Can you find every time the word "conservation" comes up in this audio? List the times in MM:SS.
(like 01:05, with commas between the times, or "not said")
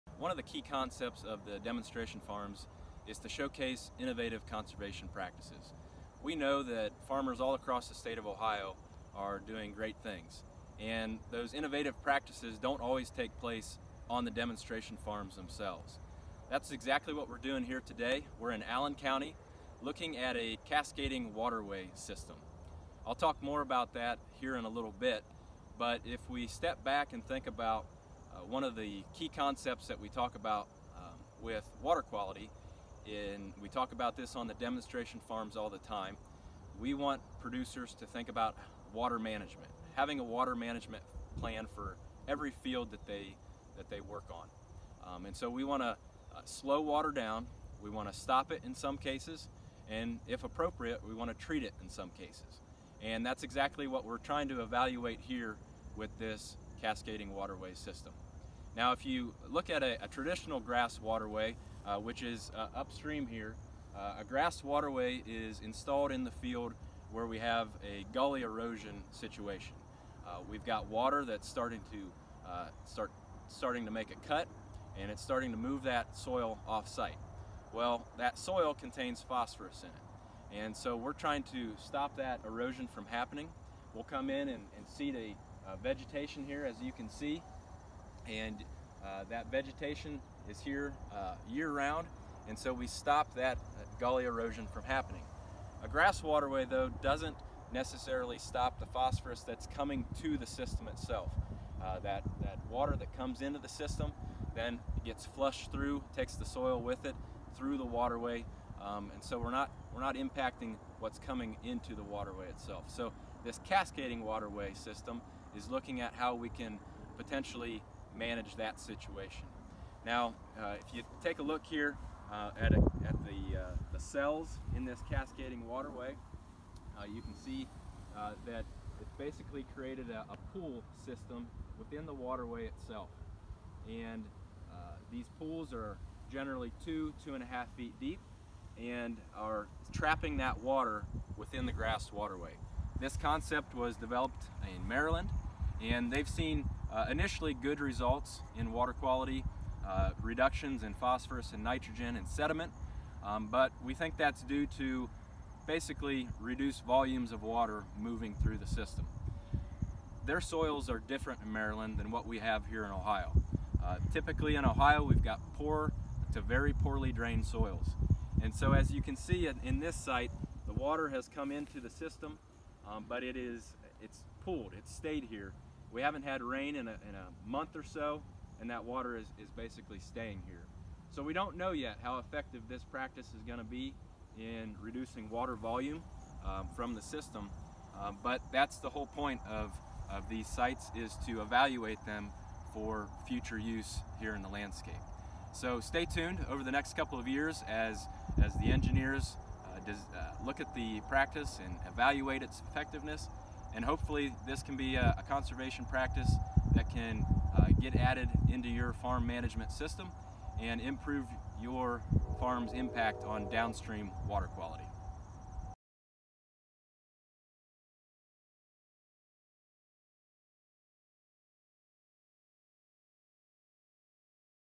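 00:04, 03:25.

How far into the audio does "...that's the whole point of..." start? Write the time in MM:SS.
03:08.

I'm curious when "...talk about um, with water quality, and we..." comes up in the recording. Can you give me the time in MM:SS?
00:30.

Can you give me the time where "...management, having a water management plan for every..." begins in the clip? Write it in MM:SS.
00:39.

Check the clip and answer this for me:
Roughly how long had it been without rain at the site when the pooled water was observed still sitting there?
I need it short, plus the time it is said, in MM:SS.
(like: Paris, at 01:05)
a month, at 02:57.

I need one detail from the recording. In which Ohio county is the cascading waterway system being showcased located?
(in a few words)
Allen County.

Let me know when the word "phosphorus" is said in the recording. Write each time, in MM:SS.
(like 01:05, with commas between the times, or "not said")
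01:19, 01:38, 02:30.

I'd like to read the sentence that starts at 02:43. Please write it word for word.
Uh, typically in Ohio we've got poor to very poorly drained soils.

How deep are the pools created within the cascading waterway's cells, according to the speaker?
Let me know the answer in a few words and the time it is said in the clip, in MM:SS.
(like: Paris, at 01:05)
2 to 2.5 feet, at 02:16.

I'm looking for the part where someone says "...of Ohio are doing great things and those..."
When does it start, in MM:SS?
00:08.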